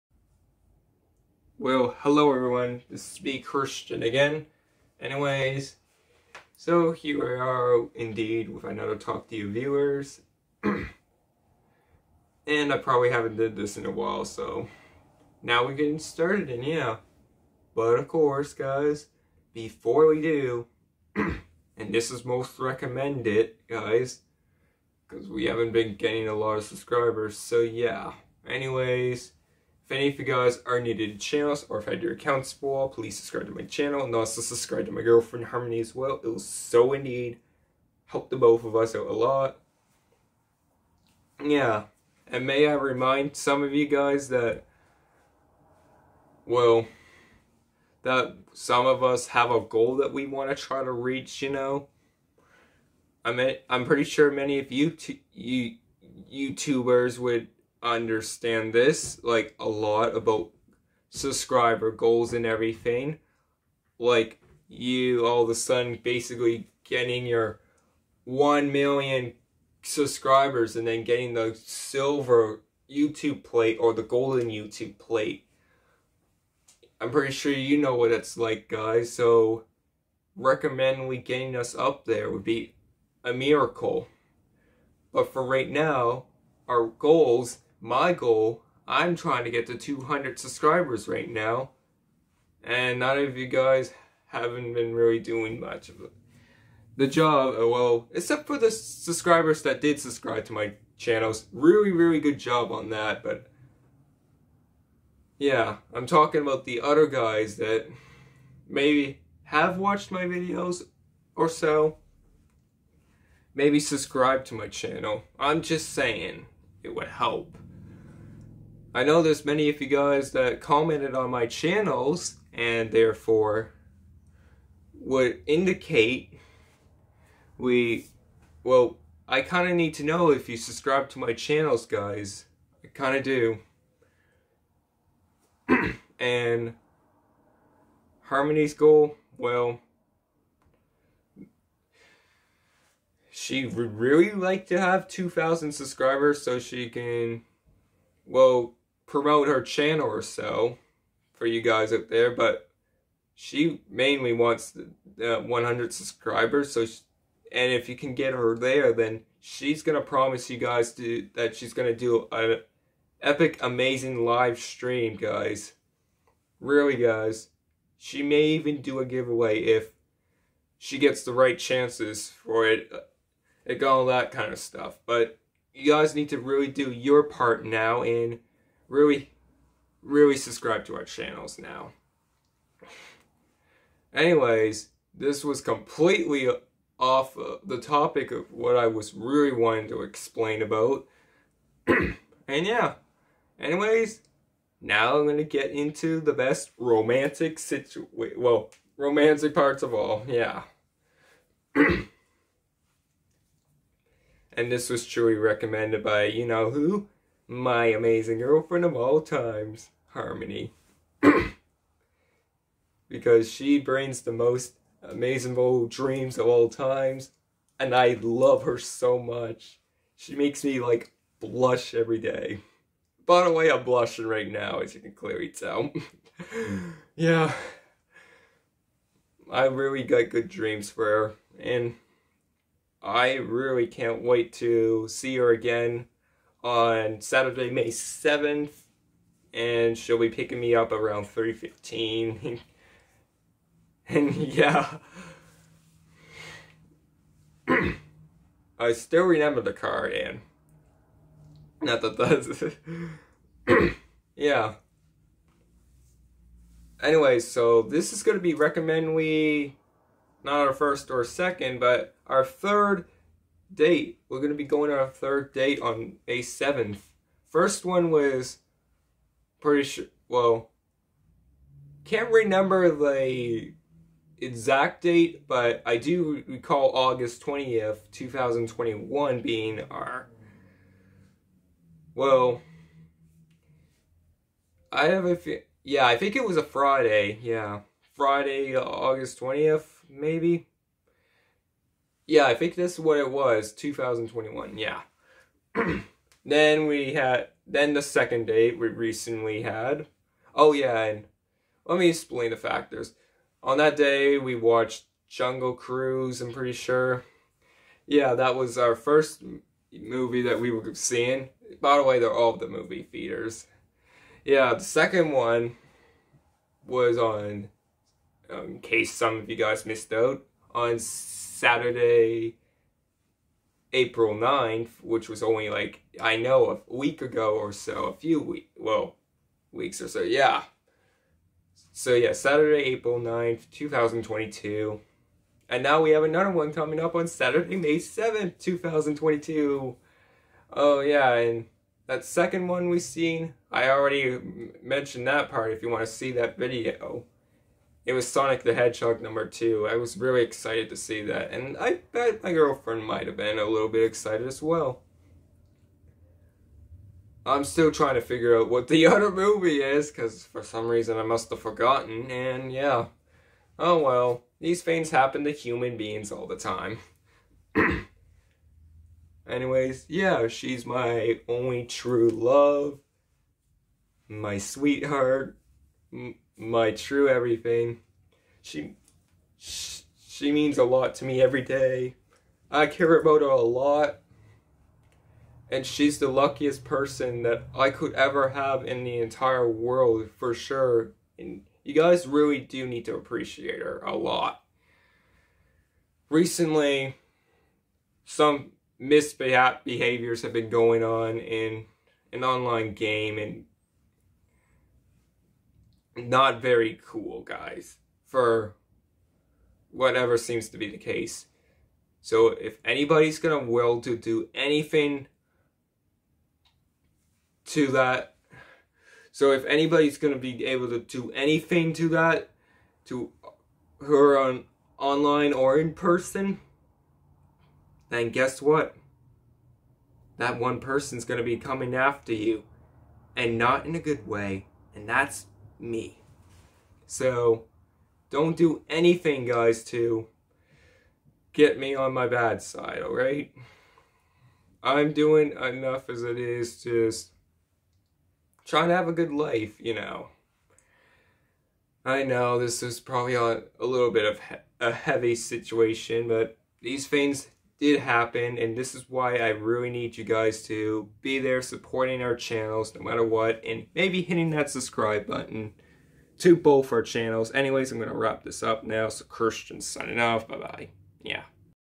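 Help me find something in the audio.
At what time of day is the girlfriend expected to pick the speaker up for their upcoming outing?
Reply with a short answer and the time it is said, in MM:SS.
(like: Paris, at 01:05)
3:15, at 04:01.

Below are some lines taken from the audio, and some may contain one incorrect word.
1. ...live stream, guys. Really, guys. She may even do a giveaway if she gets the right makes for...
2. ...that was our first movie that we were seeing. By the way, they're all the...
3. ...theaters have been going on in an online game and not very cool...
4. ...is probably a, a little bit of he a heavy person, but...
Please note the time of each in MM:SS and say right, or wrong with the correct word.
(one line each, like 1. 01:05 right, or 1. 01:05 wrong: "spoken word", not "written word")
1. 02:44 wrong: "chances", not "makes"
2. 05:08 right
3. 06:38 wrong: "misbehaviors", not "theaters"
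4. 07:32 wrong: "situation", not "person".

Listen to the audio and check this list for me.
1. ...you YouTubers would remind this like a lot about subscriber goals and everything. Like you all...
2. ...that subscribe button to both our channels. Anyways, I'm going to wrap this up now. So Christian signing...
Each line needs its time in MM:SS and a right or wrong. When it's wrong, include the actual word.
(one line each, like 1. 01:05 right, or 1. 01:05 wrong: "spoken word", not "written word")
1. 00:55 wrong: "understand", not "remind"
2. 07:44 right.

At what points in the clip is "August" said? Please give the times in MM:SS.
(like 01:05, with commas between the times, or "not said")
04:36, 04:48.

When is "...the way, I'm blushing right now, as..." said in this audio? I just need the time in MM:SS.
03:43.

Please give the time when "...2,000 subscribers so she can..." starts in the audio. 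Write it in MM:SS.
02:25.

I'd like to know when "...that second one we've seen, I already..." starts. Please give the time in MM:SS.
05:42.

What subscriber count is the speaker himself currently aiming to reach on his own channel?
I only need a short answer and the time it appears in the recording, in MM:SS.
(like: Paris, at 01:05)
200, at 01:29.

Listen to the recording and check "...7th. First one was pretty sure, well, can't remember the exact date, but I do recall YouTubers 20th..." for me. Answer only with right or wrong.
wrong.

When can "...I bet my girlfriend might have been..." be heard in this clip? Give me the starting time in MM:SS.
05:51.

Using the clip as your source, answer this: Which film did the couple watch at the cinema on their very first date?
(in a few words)
Jungle Cruise.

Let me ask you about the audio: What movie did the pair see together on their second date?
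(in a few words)
Sonic the Hedgehog 2.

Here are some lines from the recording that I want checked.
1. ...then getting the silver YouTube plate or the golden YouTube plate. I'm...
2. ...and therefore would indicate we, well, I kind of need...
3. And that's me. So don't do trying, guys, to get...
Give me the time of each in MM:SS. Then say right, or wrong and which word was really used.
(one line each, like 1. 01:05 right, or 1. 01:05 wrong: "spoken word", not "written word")
1. 01:10 right
2. 02:02 right
3. 07:14 wrong: "anything", not "trying".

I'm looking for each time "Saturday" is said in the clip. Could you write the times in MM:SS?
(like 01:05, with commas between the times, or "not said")
03:57, 05:21, 05:32, 05:37.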